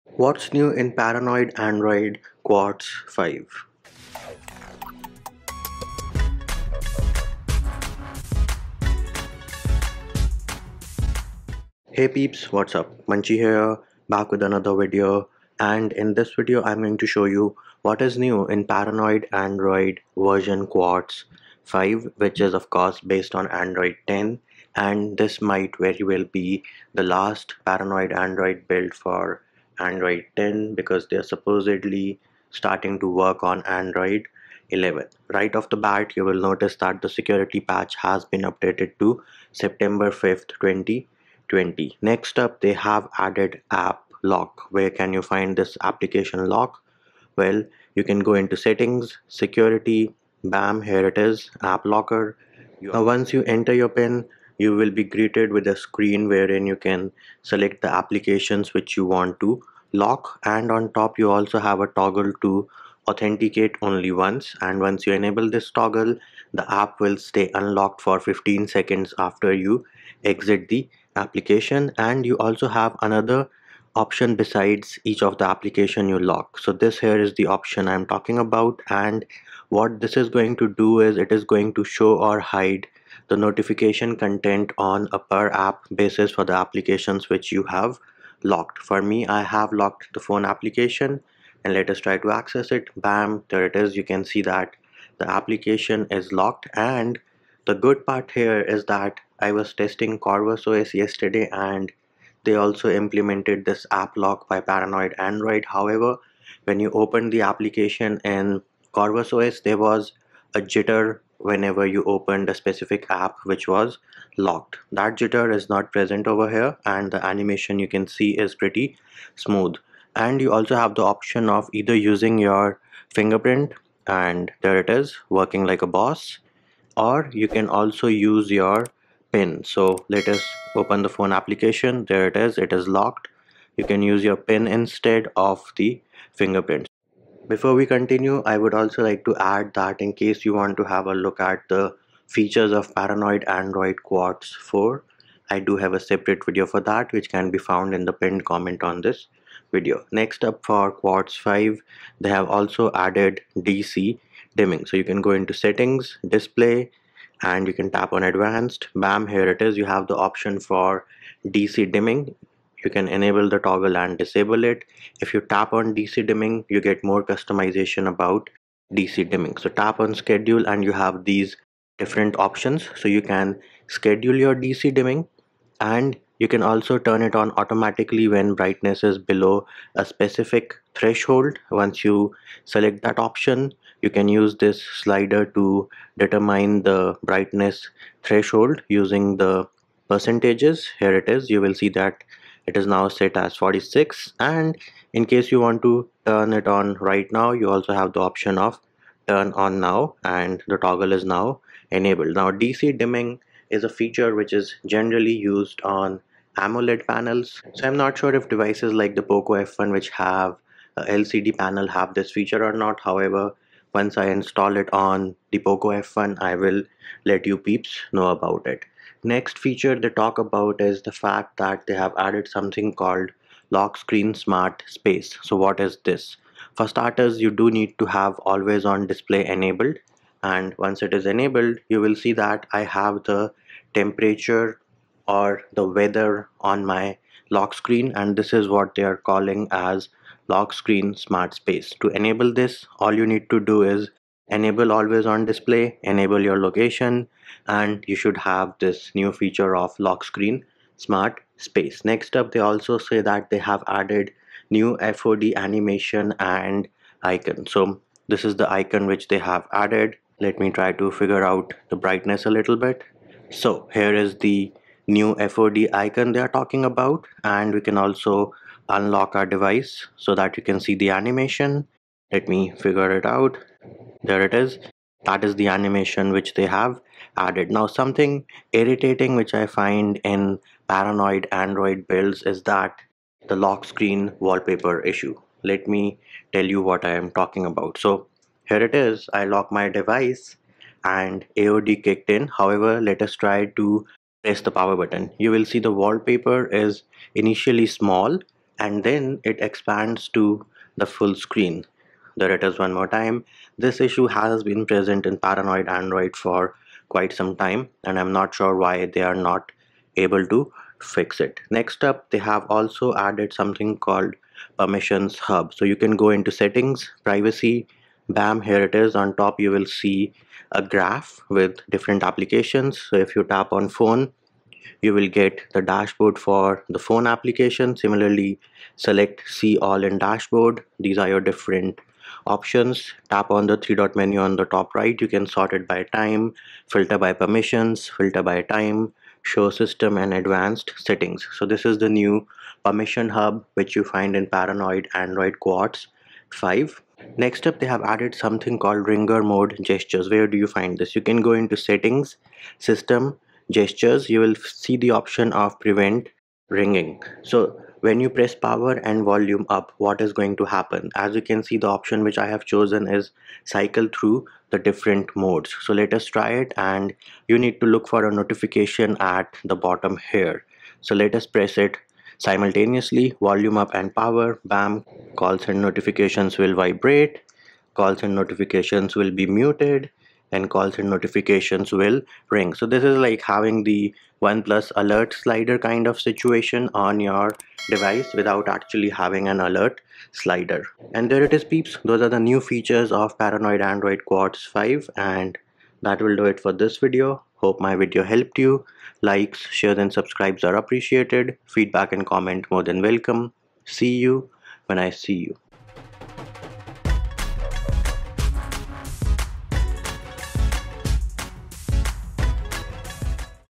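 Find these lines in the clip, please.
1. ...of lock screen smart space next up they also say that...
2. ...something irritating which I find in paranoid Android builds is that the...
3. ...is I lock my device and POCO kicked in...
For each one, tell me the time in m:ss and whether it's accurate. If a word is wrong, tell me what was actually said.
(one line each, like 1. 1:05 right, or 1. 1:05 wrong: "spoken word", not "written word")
1. 4:09 right
2. 4:37 right
3. 4:48 wrong: "AOD", not "POCO".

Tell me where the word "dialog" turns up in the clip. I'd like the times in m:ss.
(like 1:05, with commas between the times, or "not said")
not said.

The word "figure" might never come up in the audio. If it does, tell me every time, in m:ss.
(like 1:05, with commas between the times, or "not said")
4:21, 4:32.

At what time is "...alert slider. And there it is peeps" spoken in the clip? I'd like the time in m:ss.
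6:29.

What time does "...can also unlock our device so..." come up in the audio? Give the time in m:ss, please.
4:27.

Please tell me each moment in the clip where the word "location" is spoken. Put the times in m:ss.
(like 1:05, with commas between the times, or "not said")
4:06.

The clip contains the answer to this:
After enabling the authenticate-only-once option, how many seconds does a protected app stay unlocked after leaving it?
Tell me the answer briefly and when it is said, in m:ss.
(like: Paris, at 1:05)
15, at 1:08.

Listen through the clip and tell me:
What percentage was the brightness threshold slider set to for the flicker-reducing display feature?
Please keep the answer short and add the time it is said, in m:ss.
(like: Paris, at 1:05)
46, at 3:13.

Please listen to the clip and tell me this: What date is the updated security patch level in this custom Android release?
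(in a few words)
September 5th, 2020.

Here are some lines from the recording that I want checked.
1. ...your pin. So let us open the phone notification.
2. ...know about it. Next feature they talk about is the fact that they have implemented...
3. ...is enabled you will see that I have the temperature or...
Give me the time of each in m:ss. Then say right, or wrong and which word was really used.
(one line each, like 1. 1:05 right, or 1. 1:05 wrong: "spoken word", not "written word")
1. 2:08 wrong: "application", not "notification"
2. 3:38 wrong: "added", not "implemented"
3. 3:51 right.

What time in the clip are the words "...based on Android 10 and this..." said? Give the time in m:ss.
0:22.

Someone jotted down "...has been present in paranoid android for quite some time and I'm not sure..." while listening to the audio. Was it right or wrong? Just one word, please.
right.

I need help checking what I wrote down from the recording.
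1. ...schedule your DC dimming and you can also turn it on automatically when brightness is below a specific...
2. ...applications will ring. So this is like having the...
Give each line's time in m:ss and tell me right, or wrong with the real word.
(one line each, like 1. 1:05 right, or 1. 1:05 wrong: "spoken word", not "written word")
1. 2:53 right
2. 6:21 wrong: "notifications", not "applications".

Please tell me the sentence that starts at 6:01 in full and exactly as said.
As you can see, the option which I have chosen is cycle through the different modes.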